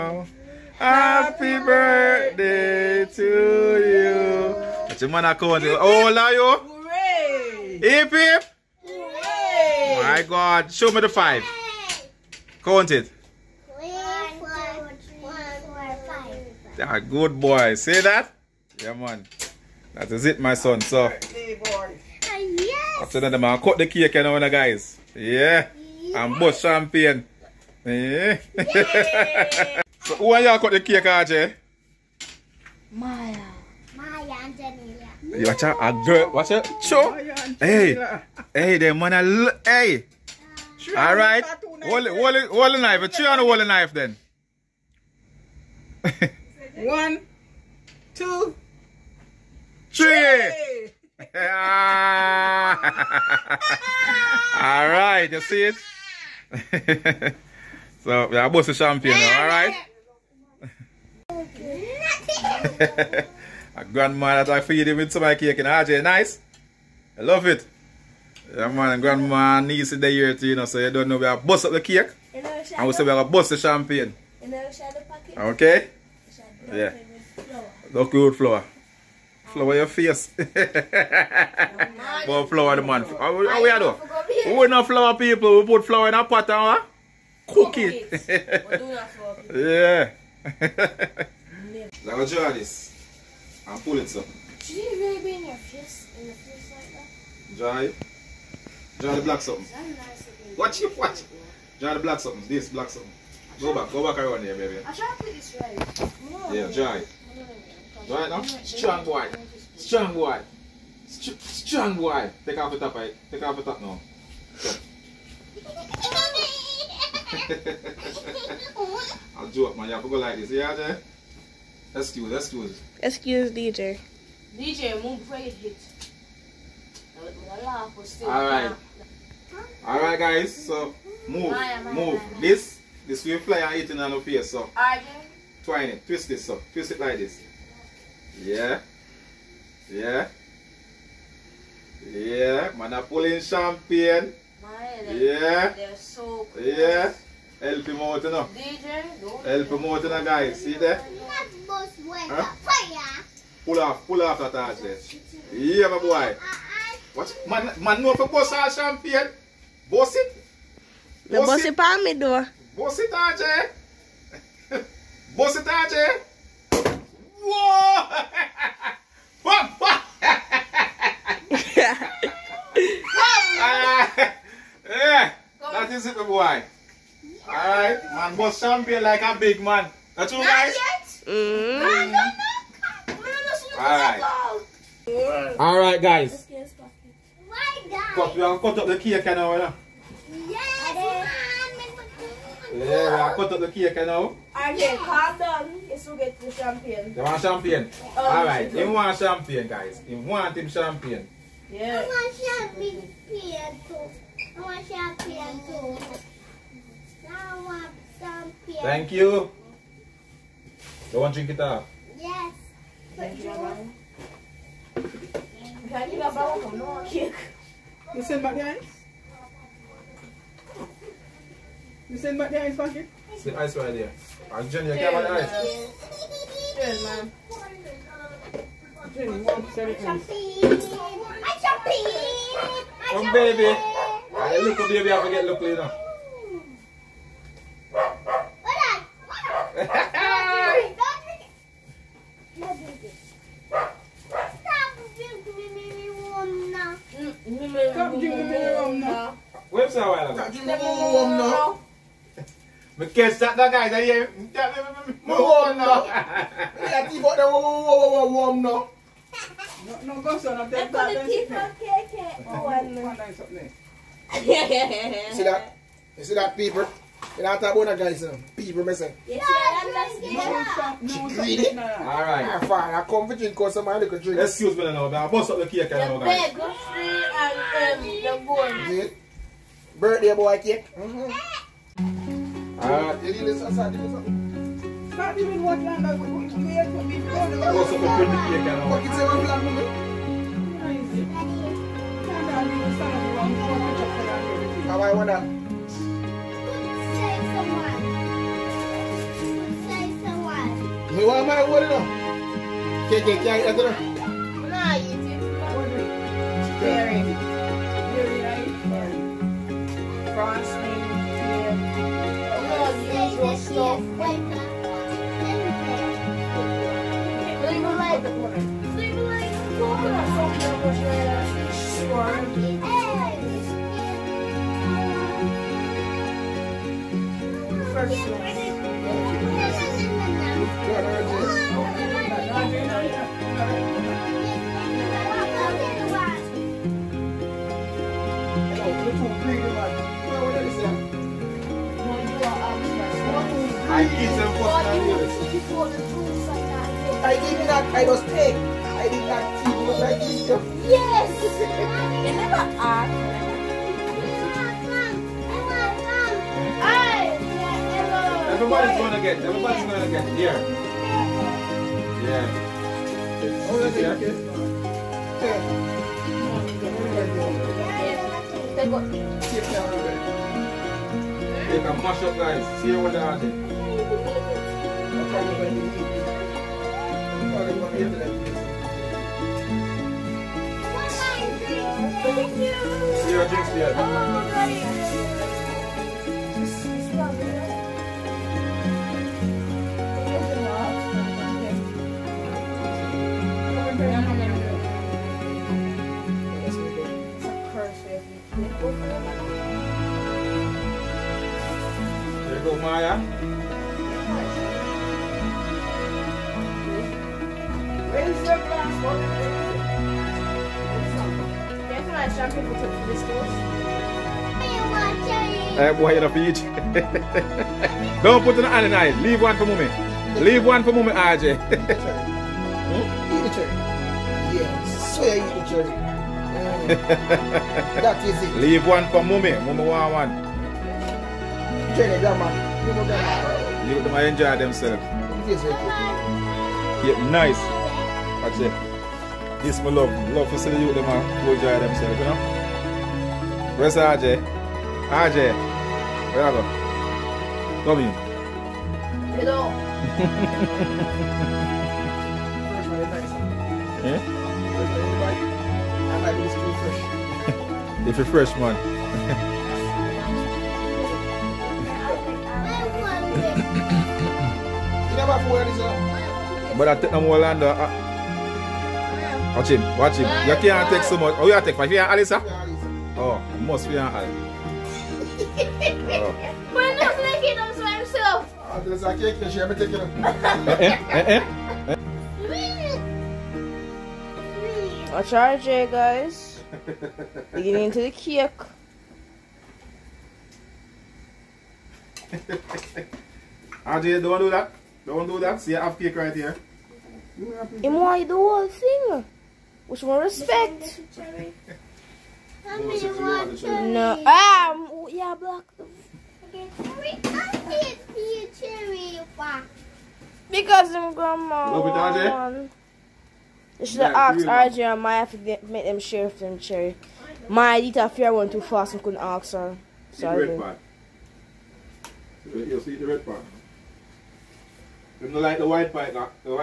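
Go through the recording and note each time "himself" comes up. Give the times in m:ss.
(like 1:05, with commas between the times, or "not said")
7:57.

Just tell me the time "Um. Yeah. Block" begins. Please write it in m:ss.
8:24.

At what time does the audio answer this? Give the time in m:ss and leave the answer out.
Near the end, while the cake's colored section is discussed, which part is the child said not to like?
8:45.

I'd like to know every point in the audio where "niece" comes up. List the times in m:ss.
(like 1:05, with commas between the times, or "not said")
1:09.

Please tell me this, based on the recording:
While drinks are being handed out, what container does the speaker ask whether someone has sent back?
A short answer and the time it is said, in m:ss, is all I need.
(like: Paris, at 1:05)
ice bucket, at 3:42.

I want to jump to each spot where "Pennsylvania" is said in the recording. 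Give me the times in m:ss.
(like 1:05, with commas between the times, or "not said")
not said.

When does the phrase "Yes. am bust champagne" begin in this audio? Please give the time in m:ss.
0:26.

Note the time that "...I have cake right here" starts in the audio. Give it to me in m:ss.
8:15.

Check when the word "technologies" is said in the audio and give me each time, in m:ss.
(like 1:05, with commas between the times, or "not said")
not said.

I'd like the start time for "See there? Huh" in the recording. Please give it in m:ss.
2:30.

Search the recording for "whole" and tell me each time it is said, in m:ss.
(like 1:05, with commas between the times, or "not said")
8:18.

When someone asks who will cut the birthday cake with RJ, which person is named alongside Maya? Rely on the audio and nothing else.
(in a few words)
Janila.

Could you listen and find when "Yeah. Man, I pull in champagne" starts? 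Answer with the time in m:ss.
2:22.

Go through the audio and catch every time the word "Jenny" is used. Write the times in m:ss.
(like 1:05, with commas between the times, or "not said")
3:44, 3:49.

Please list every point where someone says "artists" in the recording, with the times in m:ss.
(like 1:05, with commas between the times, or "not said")
not said.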